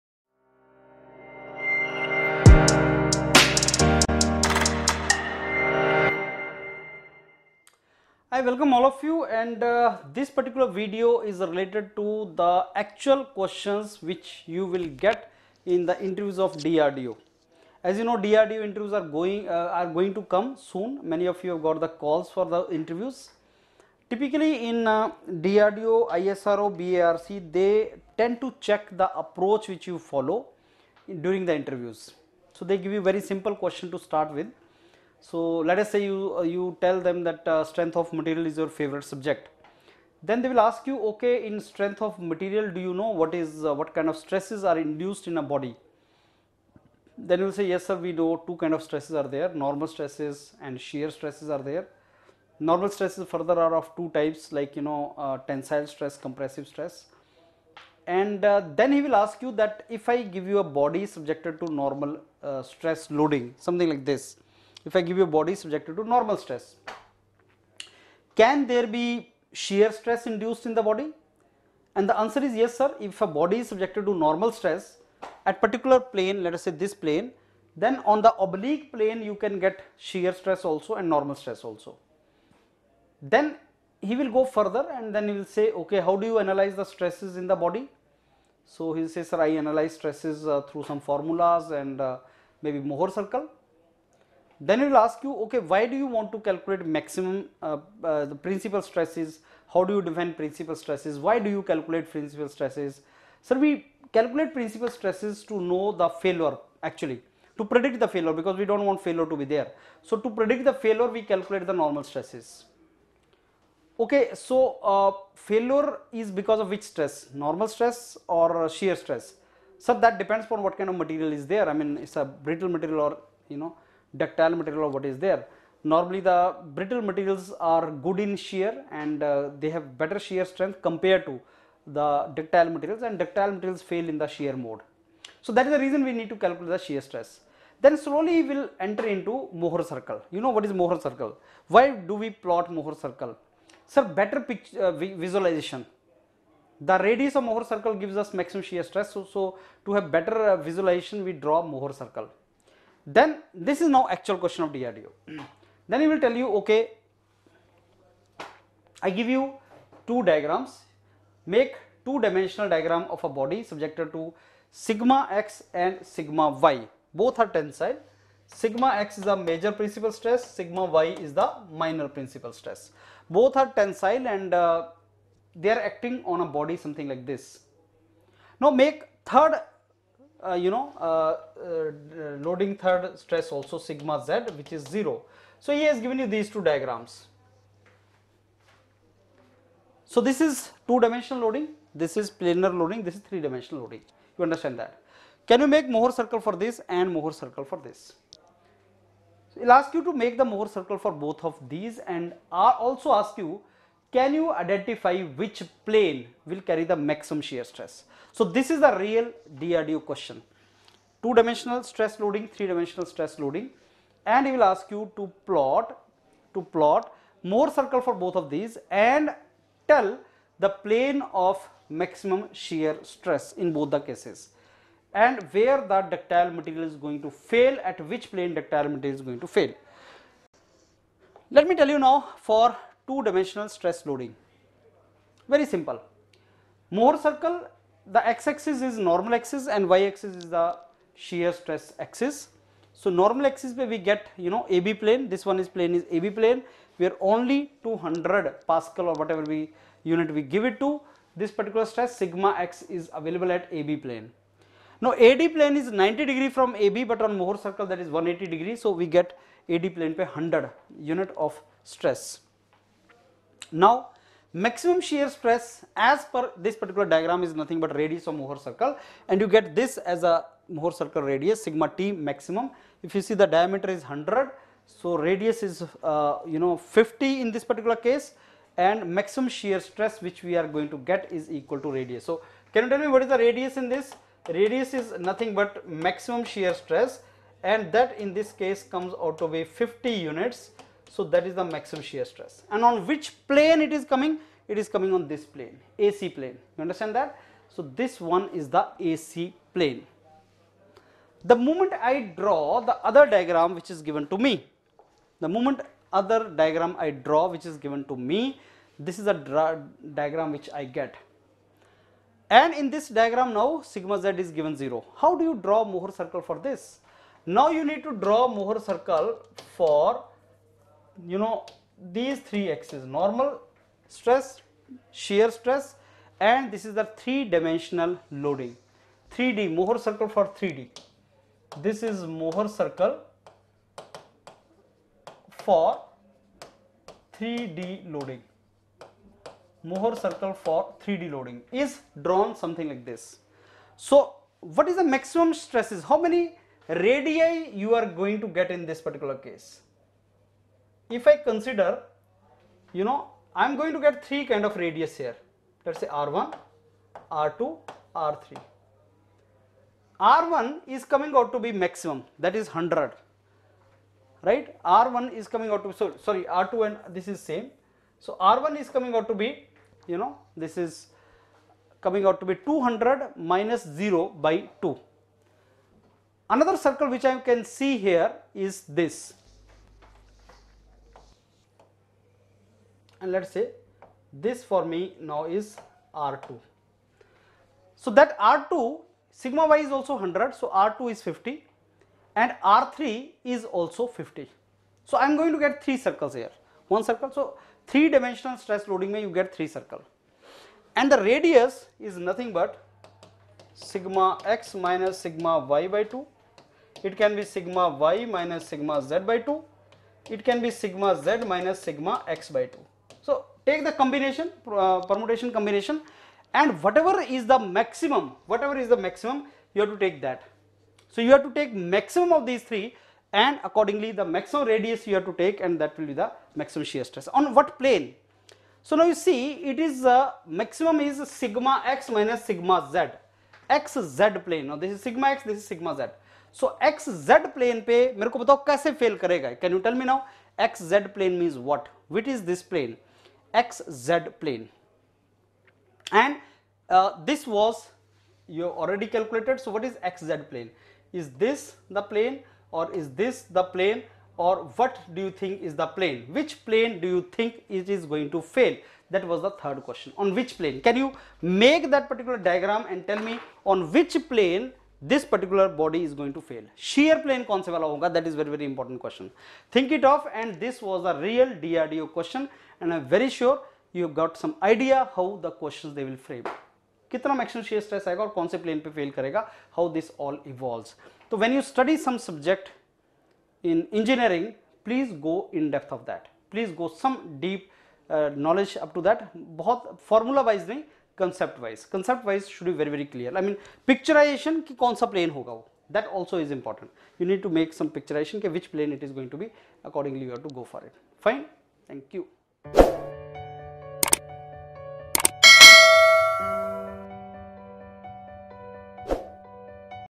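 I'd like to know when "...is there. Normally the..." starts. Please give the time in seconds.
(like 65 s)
125 s.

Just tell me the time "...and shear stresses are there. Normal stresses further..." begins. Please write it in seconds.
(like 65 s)
50 s.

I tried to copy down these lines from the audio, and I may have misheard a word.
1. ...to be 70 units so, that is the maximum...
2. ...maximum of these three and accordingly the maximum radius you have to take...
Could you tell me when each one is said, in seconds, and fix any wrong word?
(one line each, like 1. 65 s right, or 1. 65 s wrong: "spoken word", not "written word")
1. 289 s wrong: "50", not "70"
2. 421 s right.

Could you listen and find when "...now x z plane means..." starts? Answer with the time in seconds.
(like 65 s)
440 s.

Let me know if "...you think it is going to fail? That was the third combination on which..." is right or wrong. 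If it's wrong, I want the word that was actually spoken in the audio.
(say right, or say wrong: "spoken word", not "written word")
wrong: "question", not "combination".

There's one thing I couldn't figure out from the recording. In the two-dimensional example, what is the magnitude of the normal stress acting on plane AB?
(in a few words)
200.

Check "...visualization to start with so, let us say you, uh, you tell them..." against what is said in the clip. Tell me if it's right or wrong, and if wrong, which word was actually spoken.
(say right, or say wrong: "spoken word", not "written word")
wrong: "question", not "visualization".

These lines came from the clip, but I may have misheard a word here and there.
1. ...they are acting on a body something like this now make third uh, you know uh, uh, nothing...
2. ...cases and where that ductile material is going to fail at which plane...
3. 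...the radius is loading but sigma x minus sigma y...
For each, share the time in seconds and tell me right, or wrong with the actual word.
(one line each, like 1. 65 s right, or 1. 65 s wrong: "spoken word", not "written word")
1. 175 s wrong: "loading", not "nothing"
2. 223 s right
3. 401 s wrong: "nothing", not "loading".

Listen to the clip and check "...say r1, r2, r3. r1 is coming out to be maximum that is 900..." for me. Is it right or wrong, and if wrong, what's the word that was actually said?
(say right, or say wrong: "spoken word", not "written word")
wrong: "100", not "900".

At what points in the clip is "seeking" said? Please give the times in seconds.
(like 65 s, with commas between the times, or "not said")
not said.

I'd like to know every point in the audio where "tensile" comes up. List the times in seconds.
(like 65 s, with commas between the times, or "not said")
55 s, 167 s, 173 s.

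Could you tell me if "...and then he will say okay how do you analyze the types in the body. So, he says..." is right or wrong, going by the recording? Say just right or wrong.
wrong.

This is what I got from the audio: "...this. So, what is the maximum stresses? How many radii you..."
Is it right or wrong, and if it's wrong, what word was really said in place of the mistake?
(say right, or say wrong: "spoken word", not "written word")
right.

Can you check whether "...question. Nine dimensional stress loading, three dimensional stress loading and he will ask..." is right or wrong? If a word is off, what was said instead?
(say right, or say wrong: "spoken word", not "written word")
wrong: "Two", not "Nine".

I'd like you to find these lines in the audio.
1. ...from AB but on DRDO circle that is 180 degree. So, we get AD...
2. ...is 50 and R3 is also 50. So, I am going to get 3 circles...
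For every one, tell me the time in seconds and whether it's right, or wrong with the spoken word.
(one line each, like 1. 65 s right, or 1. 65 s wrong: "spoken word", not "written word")
1. 256 s wrong: "Mohr", not "DRDO"
2. 391 s right.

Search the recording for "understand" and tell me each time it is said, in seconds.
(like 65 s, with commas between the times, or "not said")
194 s, 296 s.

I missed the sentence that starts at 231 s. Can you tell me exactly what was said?
Let me tell you now for two dimensional stress loading very simple.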